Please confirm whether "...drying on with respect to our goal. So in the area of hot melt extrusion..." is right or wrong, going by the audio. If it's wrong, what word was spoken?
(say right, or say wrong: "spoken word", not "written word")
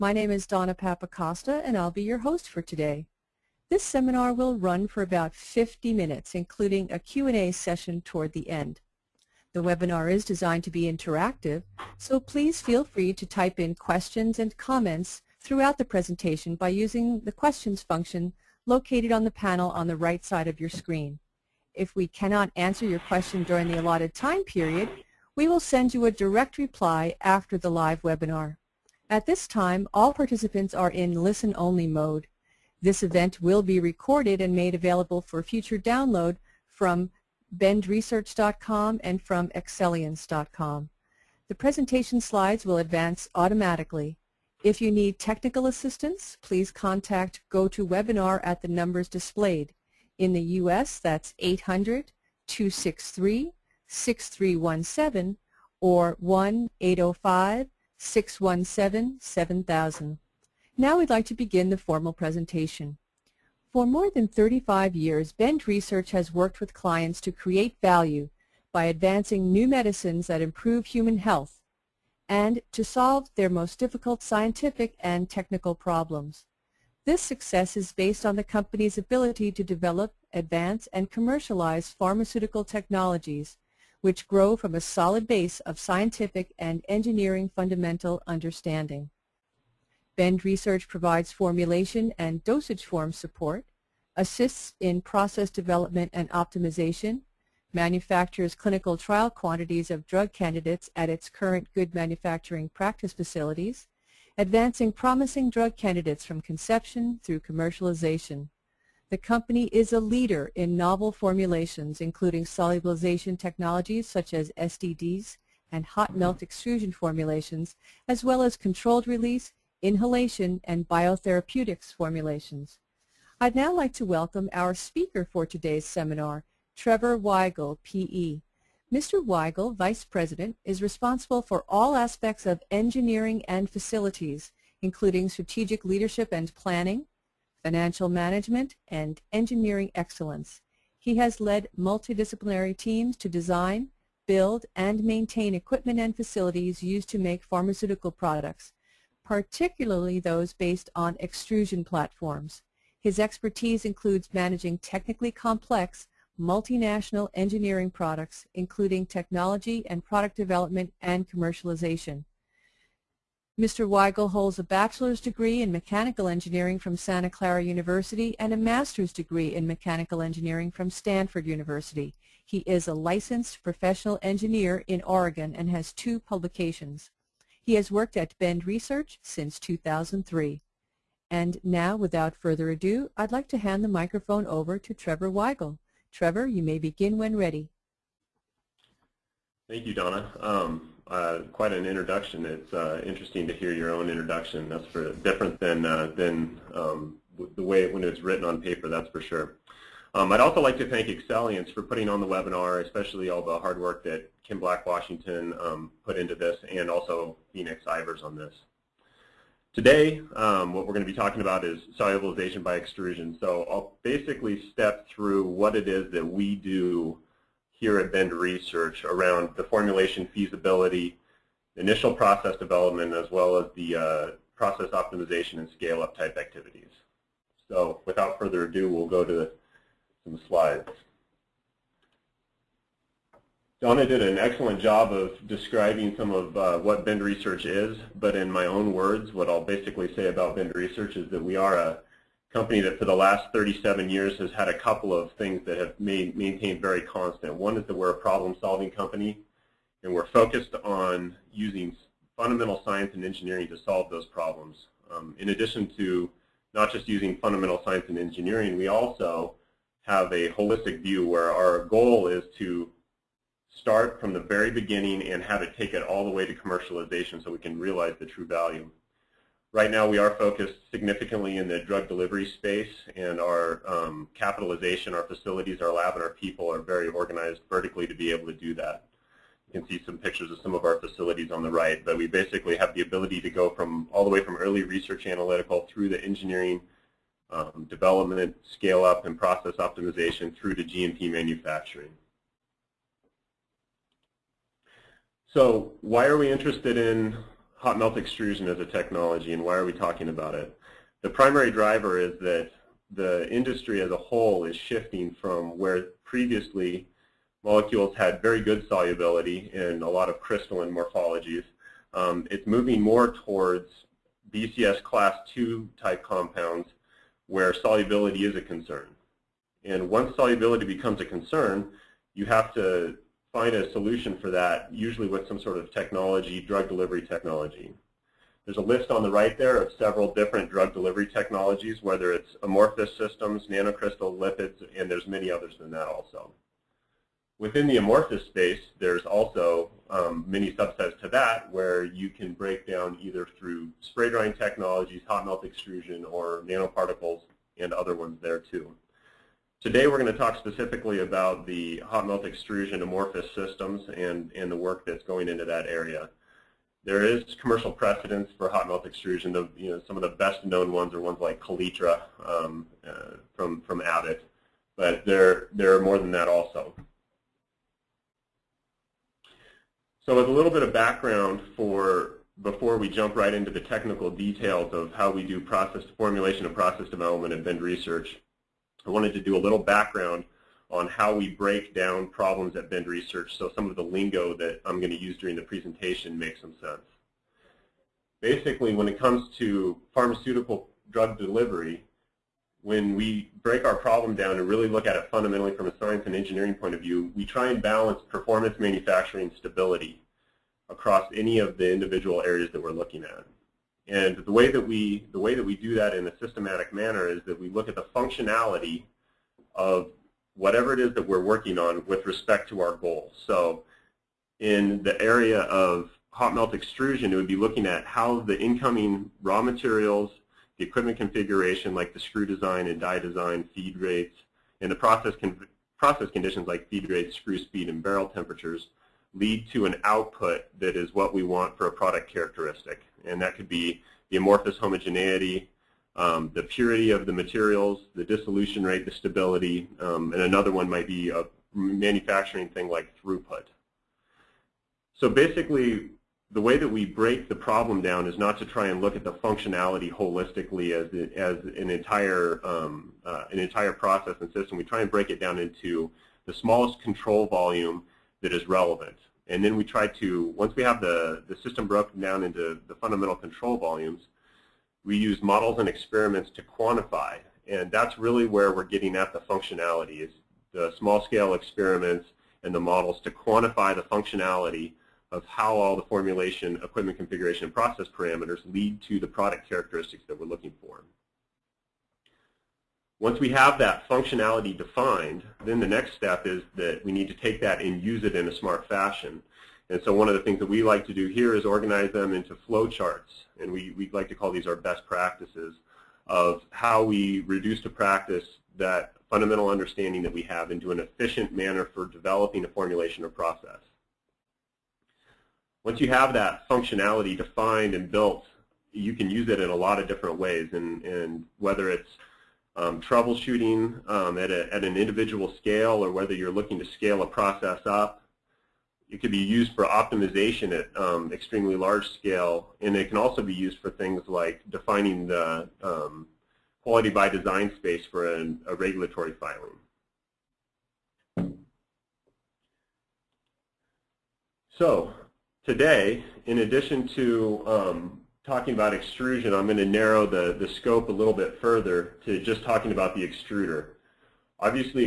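wrong: "working", not "drying".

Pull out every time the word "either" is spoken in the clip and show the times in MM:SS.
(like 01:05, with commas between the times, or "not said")
05:43.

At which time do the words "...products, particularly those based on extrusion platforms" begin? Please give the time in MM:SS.
02:28.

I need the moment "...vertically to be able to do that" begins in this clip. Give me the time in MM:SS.
04:37.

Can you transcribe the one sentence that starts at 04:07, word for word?
One is that we're a problem-solving company, and we're focused on using fundamental science and engineering to solve those problems.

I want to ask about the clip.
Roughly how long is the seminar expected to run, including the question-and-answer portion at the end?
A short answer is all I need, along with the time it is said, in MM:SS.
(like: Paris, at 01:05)
50 minutes, at 00:05.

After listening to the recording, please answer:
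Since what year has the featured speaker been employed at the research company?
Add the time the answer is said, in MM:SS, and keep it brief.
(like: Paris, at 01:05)
2003, at 02:59.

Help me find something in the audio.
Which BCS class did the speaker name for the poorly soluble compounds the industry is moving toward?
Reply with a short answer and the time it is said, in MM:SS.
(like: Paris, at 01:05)
Class 2, at 05:14.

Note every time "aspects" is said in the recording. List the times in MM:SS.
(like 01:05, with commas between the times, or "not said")
02:11.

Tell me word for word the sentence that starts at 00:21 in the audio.
If we cannot answer your question during the allotted time period, we will send you a direct reply after the live webinar.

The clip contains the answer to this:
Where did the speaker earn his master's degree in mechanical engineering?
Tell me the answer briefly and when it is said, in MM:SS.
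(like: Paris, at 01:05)
Stanford University, at 02:50.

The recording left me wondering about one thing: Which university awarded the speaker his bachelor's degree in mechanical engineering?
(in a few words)
Santa Clara University.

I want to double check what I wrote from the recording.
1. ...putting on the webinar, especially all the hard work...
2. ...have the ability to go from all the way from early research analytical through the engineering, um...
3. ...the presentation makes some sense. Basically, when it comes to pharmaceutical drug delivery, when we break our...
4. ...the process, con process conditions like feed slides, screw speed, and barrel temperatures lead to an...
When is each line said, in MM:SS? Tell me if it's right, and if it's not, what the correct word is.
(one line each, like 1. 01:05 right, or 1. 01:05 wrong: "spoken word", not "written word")
1. 03:21 right
2. 04:42 right
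3. 06:25 right
4. 07:04 wrong: "rates", not "slides".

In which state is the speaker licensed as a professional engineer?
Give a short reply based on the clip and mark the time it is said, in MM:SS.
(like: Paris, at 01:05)
Oregon, at 02:55.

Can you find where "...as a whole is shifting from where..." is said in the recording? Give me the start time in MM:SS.
05:03.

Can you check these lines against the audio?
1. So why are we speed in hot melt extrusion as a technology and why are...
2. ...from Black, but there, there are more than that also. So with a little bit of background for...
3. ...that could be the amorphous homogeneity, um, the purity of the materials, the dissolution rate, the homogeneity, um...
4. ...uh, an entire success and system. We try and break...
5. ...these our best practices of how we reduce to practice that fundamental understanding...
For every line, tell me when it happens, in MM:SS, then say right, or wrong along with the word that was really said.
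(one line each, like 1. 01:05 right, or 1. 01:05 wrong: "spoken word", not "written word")
1. 04:55 wrong: "interested", not "speed"
2. 06:03 wrong: "Abbott", not "Black"
3. 07:13 wrong: "stability", not "homogeneity"
4. 07:33 wrong: "process", not "success"
5. 08:14 right.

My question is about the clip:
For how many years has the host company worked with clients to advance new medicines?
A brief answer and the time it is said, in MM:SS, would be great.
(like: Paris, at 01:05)
More than 35, at 01:03.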